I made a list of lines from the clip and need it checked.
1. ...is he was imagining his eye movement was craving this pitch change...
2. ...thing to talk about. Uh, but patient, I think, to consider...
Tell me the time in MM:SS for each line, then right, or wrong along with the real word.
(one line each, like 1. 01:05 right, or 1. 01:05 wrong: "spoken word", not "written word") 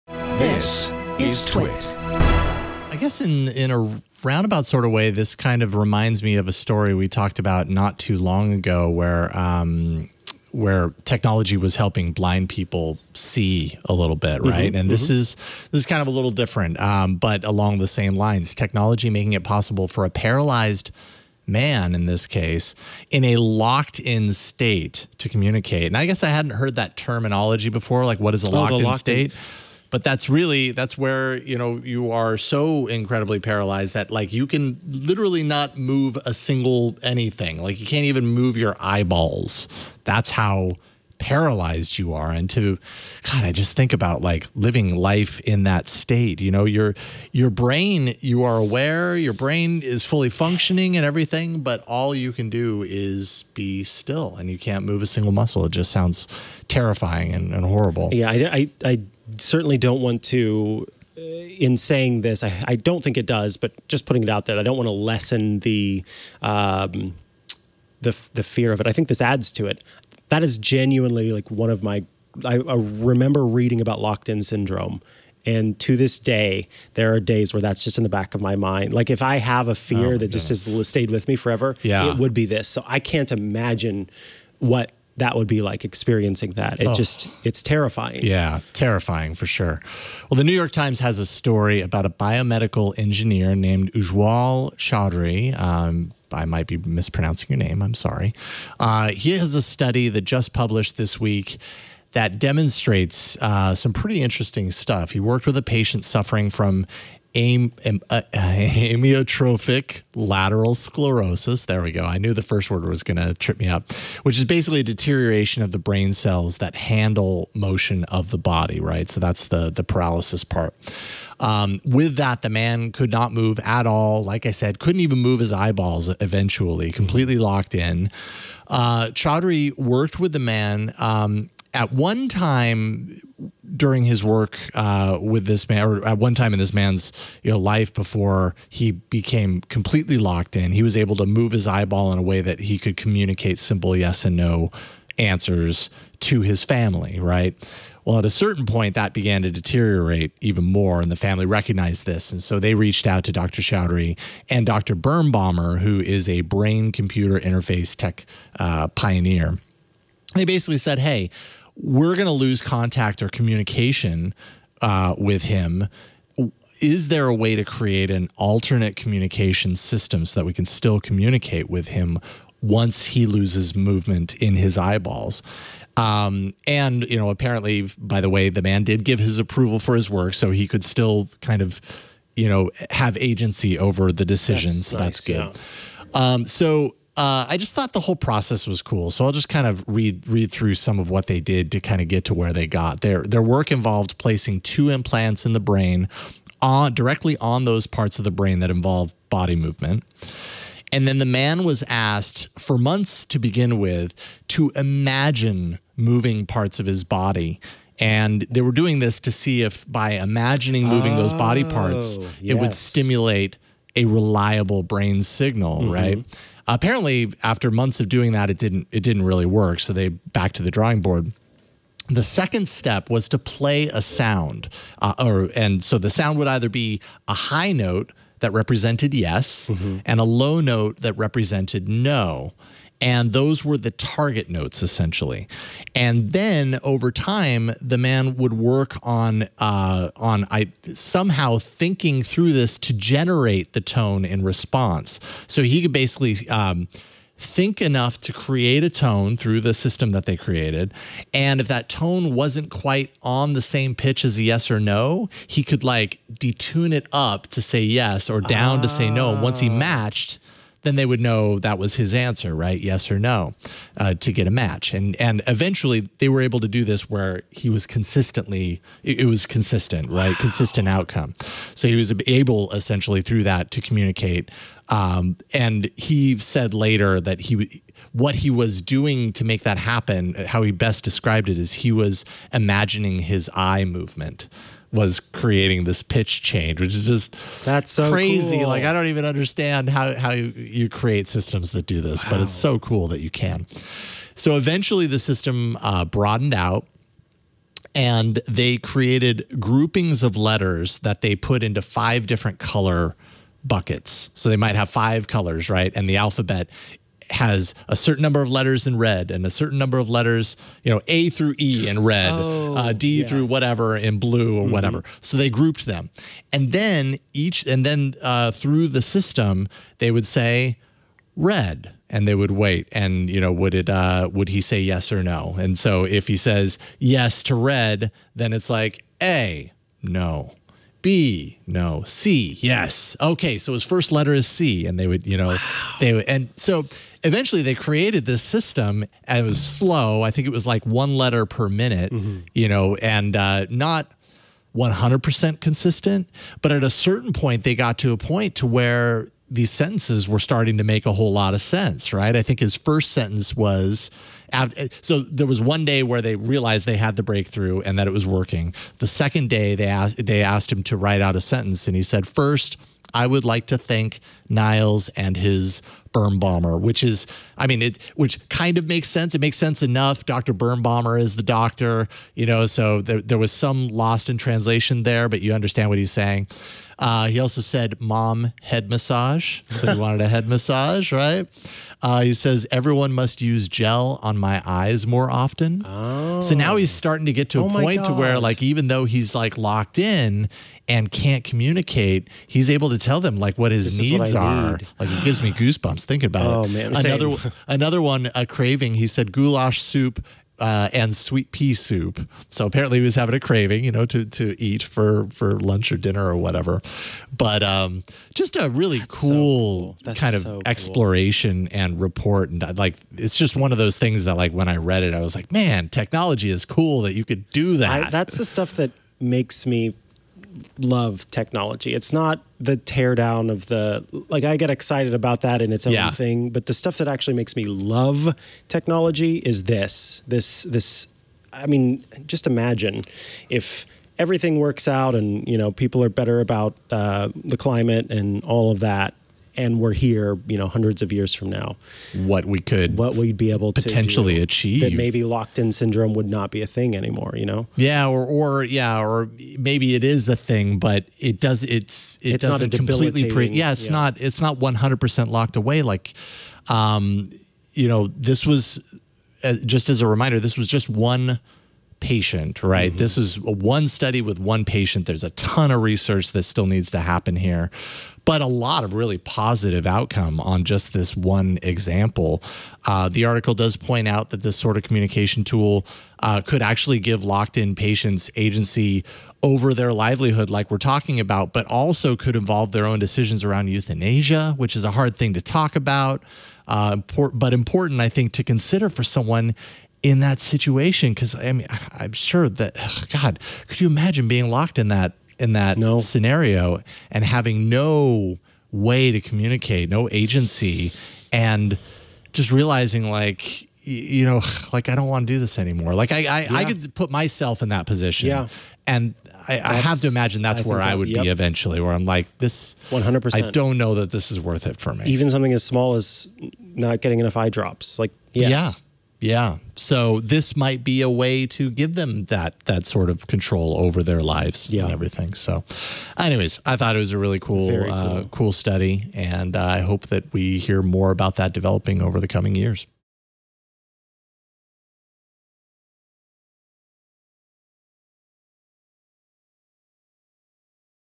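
1. 04:41 wrong: "creating", not "craving"
2. 08:05 wrong: "important", not "patient".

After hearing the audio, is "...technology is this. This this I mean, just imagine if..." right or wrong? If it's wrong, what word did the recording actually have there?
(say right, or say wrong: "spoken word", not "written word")
right.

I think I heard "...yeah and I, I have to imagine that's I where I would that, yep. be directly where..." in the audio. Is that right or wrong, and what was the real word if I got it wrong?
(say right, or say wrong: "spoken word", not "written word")
wrong: "eventually", not "directly".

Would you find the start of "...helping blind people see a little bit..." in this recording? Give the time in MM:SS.
00:11.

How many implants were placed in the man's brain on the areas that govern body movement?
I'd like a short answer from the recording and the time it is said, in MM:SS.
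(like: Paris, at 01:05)
2, at 03:14.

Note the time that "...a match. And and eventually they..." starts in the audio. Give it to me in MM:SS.
04:24.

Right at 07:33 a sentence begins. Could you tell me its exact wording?
not, it's not 100% locked away.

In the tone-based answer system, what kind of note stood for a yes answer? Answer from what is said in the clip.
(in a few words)
High note.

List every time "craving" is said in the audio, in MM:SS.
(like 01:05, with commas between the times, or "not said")
06:38, 06:43.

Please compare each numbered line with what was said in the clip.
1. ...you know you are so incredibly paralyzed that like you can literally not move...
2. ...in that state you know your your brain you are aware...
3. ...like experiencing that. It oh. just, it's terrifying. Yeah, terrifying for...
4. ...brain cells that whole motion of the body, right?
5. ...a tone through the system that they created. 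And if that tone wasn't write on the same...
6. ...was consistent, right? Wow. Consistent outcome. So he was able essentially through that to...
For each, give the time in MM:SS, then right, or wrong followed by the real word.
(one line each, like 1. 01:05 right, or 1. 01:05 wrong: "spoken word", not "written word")
1. 00:31 right
2. 00:45 right
3. 01:25 right
4. 01:55 wrong: "handle", not "whole"
5. 04:08 wrong: "quite", not "write"
6. 04:29 right.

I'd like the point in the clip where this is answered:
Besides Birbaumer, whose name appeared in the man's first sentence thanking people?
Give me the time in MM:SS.
06:04.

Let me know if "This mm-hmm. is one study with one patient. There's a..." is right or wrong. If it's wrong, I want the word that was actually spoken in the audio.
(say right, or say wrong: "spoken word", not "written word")
right.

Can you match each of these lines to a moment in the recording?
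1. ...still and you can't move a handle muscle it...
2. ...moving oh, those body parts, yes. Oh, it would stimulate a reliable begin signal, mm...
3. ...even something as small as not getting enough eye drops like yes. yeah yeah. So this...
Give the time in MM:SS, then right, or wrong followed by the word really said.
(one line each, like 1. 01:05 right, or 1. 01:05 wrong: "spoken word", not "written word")
1. 00:53 wrong: "single", not "handle"
2. 03:30 wrong: "brain", not "begin"
3. 08:35 right.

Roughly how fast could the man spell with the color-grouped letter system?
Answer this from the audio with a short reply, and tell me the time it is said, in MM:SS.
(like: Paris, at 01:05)
1 letter per minute, at 05:40.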